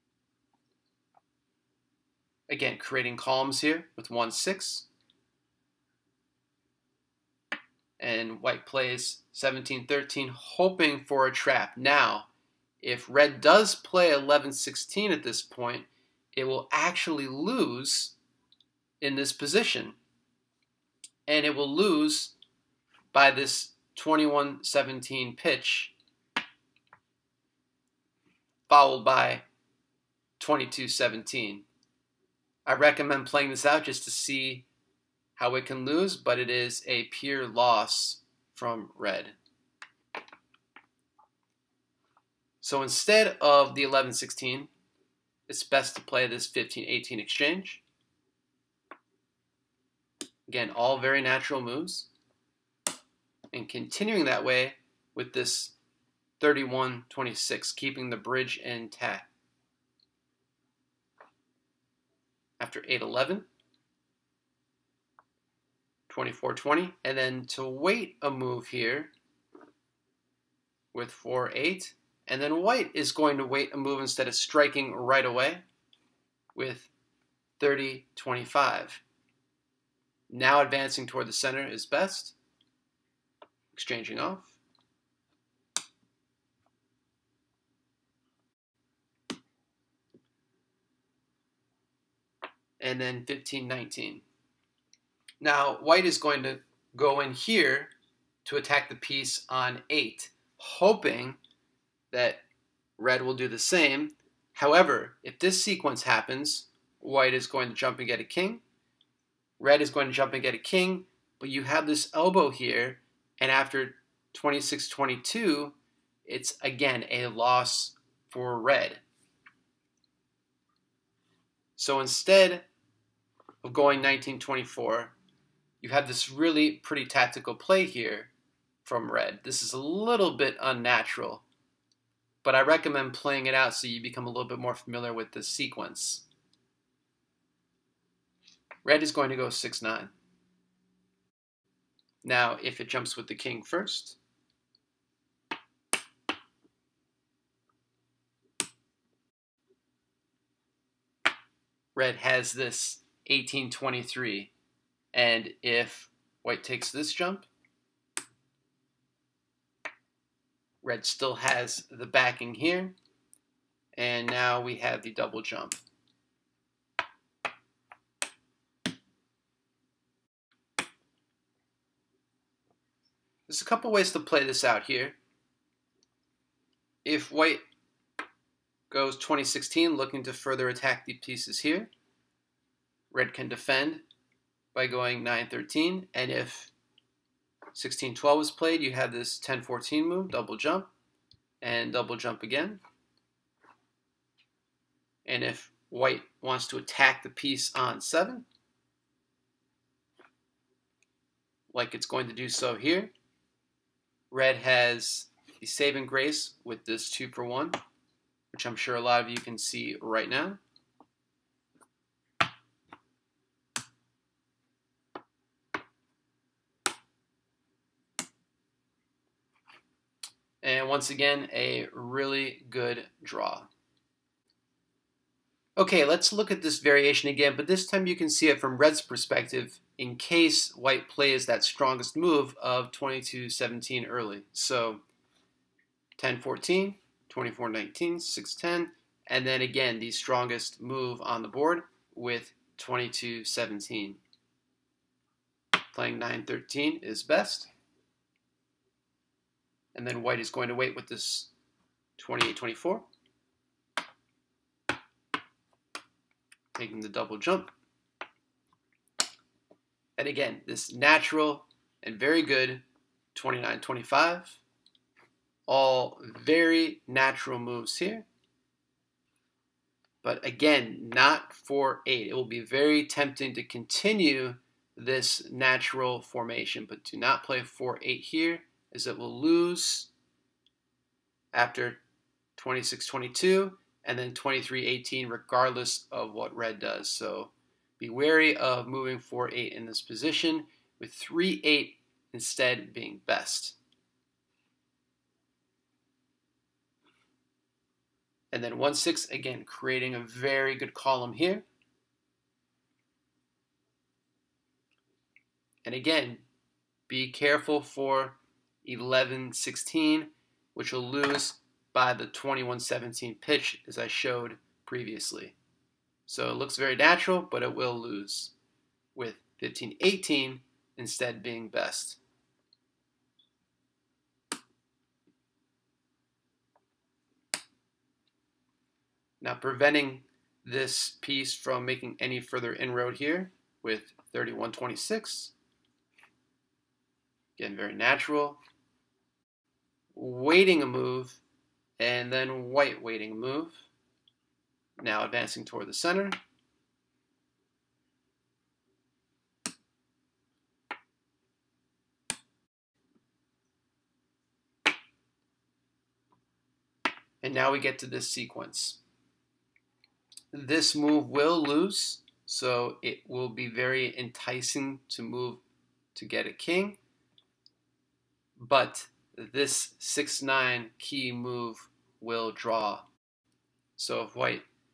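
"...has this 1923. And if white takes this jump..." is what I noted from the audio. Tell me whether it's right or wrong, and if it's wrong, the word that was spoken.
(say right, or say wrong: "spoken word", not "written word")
wrong: "1823", not "1923".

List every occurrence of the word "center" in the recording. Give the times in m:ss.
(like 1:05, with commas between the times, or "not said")
1:21, 5:45.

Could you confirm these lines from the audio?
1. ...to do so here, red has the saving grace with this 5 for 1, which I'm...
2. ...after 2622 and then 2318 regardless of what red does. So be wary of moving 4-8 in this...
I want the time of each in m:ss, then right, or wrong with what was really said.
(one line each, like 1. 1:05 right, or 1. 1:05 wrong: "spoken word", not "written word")
1. 3:22 wrong: "2", not "5"
2. 4:41 right.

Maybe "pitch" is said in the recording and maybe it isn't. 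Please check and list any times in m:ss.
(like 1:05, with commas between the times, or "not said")
0:25, 5:13.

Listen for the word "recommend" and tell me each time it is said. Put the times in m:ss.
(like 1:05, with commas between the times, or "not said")
0:32, 2:12.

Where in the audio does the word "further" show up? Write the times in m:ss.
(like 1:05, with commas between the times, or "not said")
3:00, 5:32.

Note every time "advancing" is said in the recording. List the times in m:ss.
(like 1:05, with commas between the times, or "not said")
1:20, 5:45.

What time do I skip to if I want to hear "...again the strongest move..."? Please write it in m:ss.
3:59.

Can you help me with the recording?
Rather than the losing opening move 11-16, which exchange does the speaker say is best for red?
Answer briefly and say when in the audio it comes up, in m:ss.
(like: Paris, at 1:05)
15-18, at 0:46.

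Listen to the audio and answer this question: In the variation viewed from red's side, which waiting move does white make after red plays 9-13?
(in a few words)
28-24.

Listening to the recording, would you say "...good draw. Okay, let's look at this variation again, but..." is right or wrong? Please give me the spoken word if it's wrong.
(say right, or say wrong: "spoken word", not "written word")
right.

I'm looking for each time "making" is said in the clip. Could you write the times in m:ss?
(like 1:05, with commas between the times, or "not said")
5:31.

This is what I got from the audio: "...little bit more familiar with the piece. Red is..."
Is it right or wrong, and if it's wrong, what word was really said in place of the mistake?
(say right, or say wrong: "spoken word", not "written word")
wrong: "sequence", not "piece".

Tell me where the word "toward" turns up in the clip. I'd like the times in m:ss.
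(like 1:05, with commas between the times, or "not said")
1:21, 5:45.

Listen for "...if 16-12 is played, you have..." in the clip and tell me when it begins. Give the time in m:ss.
3:06.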